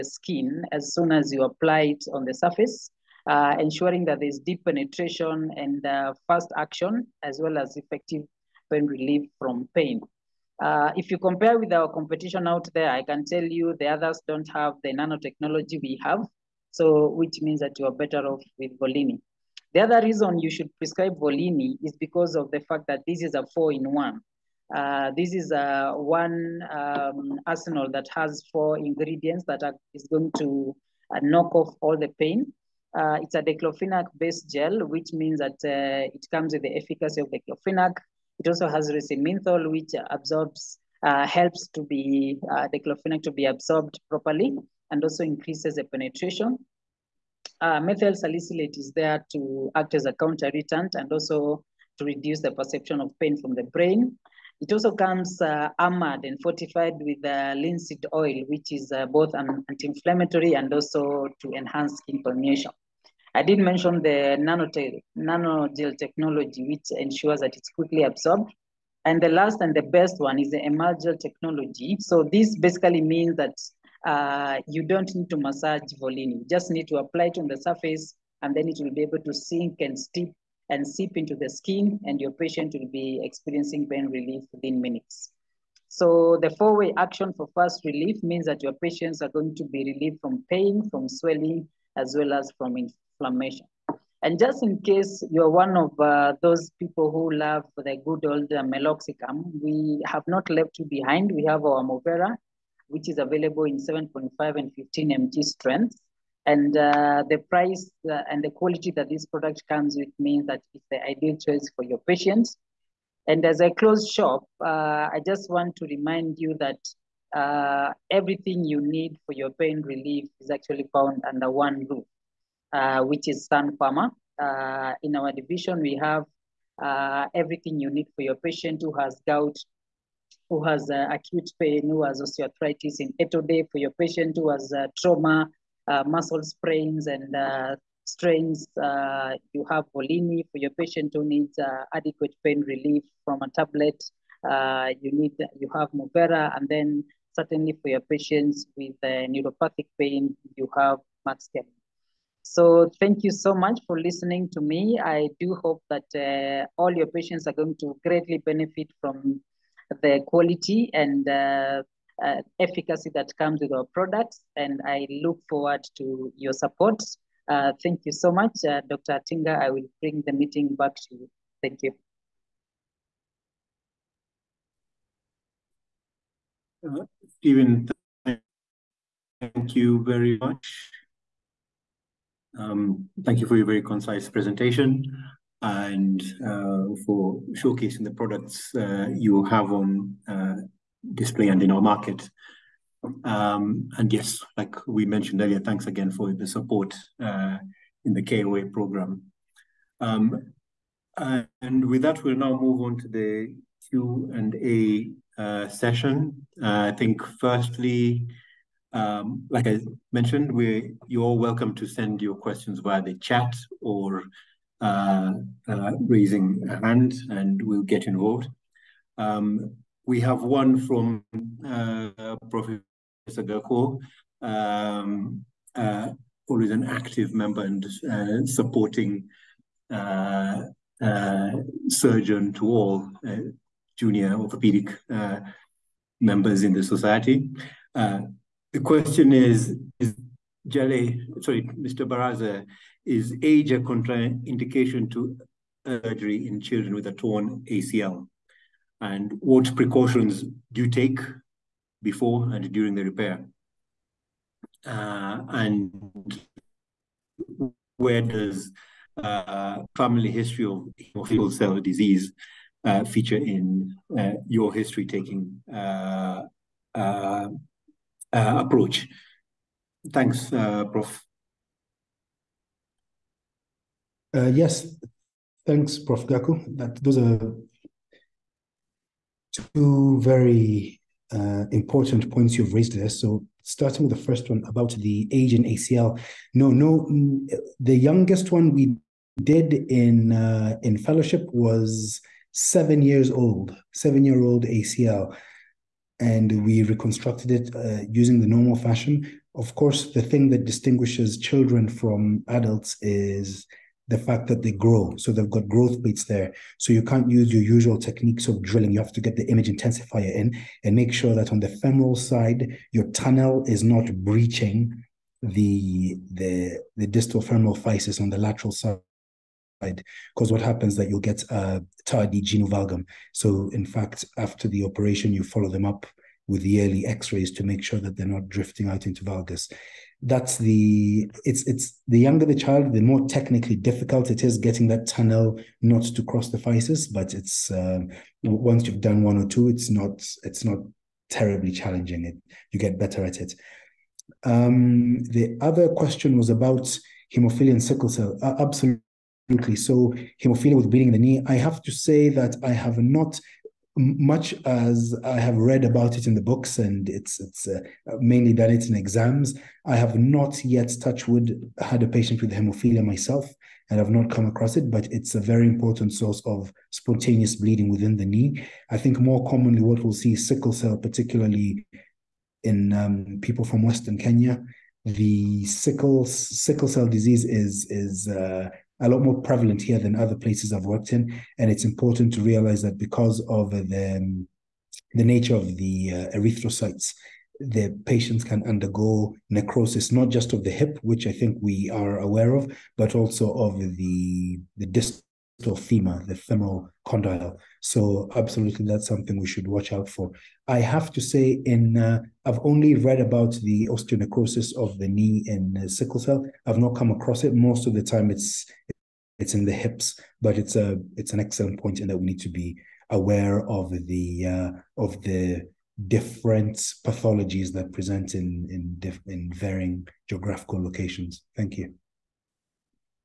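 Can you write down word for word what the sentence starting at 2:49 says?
I will bring the meeting back to you.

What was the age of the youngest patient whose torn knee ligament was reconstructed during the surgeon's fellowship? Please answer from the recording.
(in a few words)
7 years old.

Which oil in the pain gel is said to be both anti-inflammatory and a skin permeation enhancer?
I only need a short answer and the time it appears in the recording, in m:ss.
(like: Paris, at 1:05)
linseed oil, at 0:57.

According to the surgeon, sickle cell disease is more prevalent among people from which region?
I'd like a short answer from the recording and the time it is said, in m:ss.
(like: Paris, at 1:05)
Western Kenya, at 6:13.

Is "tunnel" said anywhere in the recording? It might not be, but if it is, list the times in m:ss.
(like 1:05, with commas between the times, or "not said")
5:13, 5:35.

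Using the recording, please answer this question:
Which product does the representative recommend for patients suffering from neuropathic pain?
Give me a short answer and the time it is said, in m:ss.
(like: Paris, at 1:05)
Maxgen, at 2:31.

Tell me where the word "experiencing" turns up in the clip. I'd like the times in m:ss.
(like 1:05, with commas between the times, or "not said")
1:23.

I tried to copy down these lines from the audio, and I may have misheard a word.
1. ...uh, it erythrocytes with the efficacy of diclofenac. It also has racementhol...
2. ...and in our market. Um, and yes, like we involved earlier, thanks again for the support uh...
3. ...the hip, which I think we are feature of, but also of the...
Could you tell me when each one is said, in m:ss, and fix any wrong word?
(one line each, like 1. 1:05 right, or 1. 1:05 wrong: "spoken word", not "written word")
1. 0:35 wrong: "comes", not "erythrocytes"
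2. 3:11 wrong: "mentioned", not "involved"
3. 6:30 wrong: "aware", not "feature".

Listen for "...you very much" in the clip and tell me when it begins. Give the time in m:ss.
2:59.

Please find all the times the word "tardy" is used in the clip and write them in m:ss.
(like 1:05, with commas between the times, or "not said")
5:22.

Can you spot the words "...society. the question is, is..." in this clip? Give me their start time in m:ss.
3:56.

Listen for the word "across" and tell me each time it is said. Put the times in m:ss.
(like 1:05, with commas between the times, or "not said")
6:04, 6:47.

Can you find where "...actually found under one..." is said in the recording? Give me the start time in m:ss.
2:00.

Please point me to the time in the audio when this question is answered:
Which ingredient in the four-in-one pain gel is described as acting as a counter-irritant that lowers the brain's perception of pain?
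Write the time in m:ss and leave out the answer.
0:47.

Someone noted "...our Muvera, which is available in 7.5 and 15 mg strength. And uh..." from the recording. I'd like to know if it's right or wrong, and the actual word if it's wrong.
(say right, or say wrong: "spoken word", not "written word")
right.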